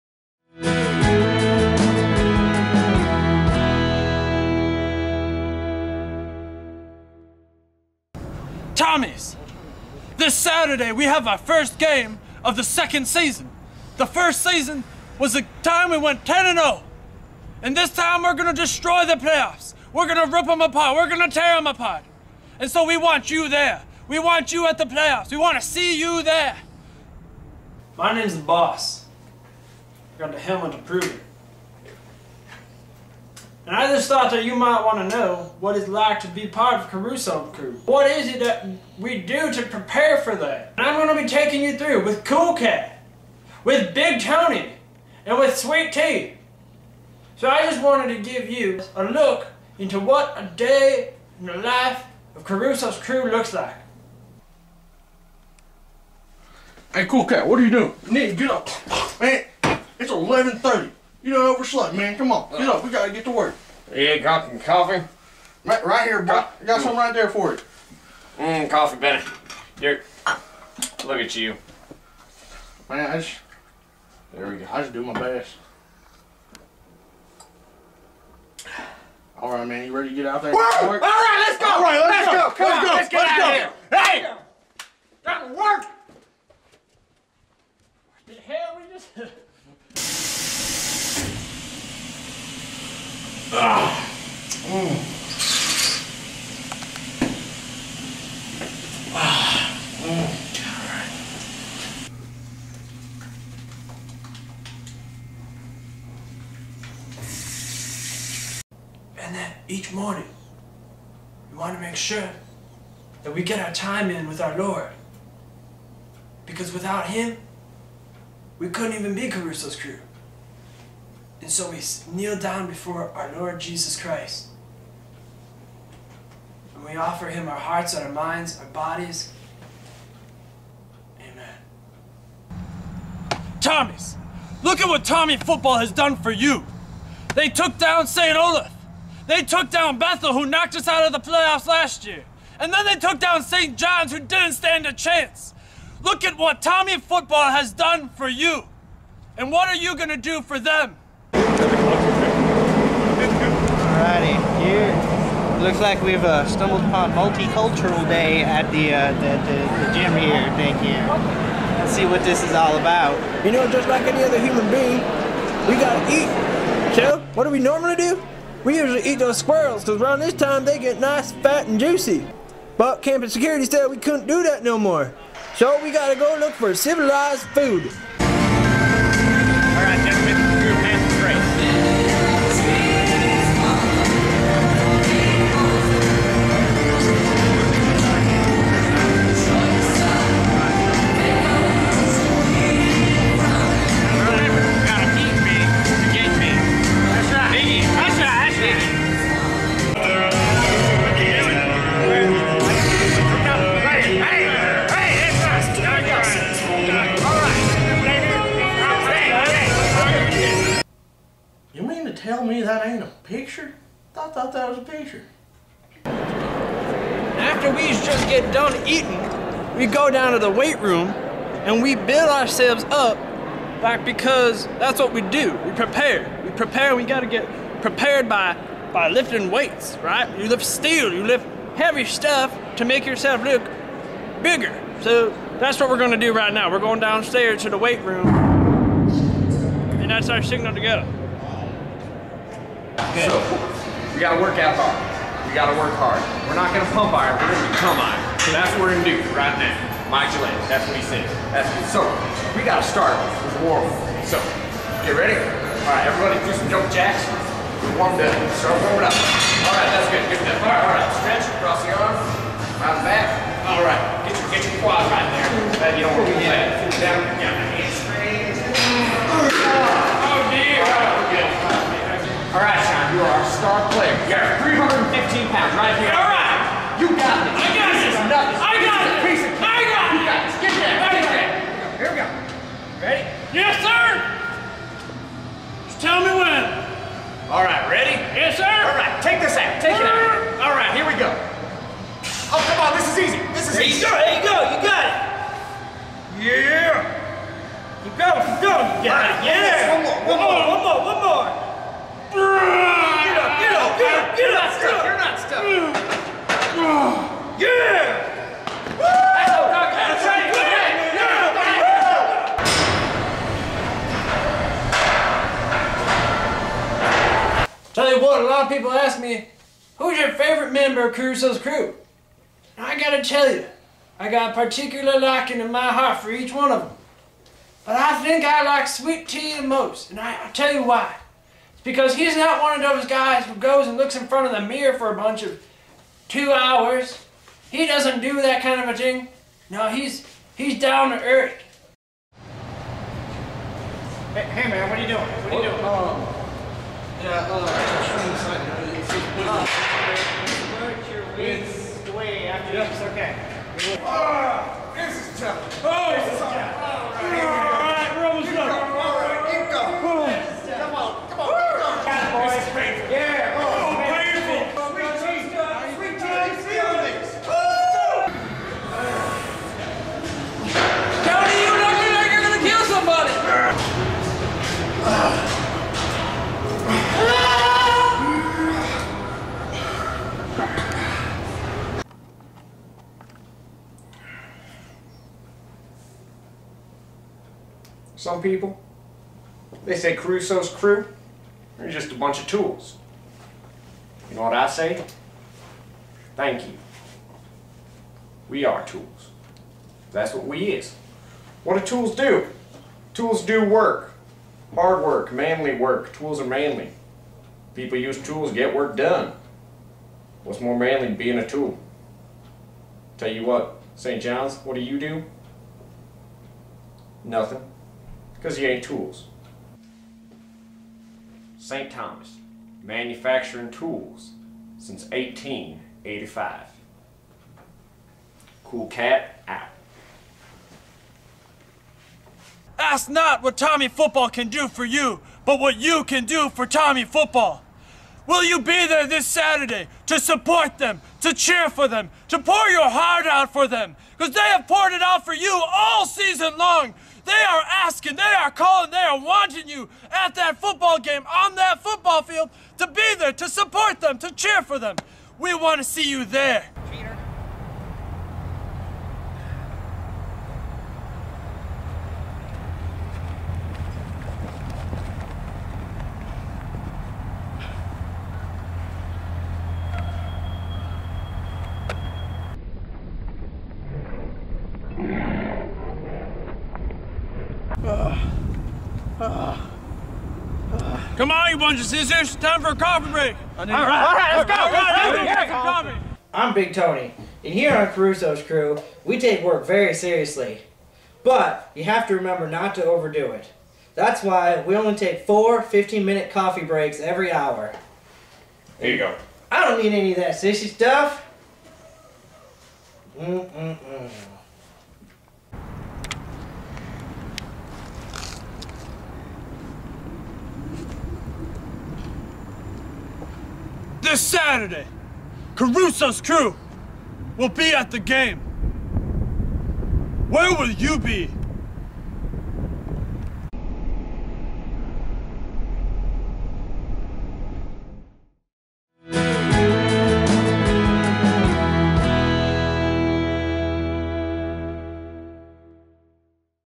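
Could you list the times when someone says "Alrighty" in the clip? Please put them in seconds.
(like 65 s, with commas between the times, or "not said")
153 s.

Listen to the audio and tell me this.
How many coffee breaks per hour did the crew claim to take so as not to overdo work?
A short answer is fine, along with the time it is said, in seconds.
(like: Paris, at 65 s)
4, at 495 s.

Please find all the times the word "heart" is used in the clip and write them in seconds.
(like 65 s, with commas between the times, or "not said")
127 s, 325 s, 442 s.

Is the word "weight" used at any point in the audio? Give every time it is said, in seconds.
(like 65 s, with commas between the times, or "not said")
220 s, 229 s, 237 s.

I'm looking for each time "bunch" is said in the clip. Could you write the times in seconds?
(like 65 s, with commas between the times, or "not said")
335 s, 392 s, 481 s.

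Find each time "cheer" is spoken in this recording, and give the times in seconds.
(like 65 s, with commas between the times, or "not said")
441 s, 454 s.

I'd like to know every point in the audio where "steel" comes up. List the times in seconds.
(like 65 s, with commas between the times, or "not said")
230 s.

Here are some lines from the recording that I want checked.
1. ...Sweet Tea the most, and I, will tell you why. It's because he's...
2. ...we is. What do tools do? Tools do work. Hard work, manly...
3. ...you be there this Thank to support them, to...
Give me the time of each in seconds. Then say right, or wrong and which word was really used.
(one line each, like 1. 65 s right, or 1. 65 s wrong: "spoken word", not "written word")
1. 328 s right
2. 400 s right
3. 438 s wrong: "Saturday", not "Thank".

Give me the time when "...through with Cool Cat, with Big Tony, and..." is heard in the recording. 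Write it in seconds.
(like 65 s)
41 s.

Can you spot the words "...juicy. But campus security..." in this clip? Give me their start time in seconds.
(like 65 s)
171 s.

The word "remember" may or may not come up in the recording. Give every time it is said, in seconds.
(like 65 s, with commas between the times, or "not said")
492 s.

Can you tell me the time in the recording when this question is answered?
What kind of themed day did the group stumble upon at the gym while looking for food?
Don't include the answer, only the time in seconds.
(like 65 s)
157 s.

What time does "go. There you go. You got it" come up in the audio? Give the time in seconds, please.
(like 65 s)
294 s.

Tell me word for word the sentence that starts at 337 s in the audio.
He doesn't do that kind of a thing.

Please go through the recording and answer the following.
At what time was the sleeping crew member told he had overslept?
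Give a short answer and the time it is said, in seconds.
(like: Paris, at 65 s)
11:30, at 60 s.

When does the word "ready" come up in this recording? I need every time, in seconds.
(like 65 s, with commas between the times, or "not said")
79 s, 255 s, 287 s.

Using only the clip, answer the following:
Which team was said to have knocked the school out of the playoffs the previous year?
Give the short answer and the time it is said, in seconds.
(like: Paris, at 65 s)
Bethel, at 139 s.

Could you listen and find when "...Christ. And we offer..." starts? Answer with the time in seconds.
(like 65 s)
123 s.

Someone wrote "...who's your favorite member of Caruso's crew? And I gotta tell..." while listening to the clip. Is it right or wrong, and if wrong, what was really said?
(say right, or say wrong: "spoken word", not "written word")
right.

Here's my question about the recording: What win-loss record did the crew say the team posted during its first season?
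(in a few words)
10-0.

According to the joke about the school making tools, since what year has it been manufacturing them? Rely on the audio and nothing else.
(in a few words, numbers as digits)
1885.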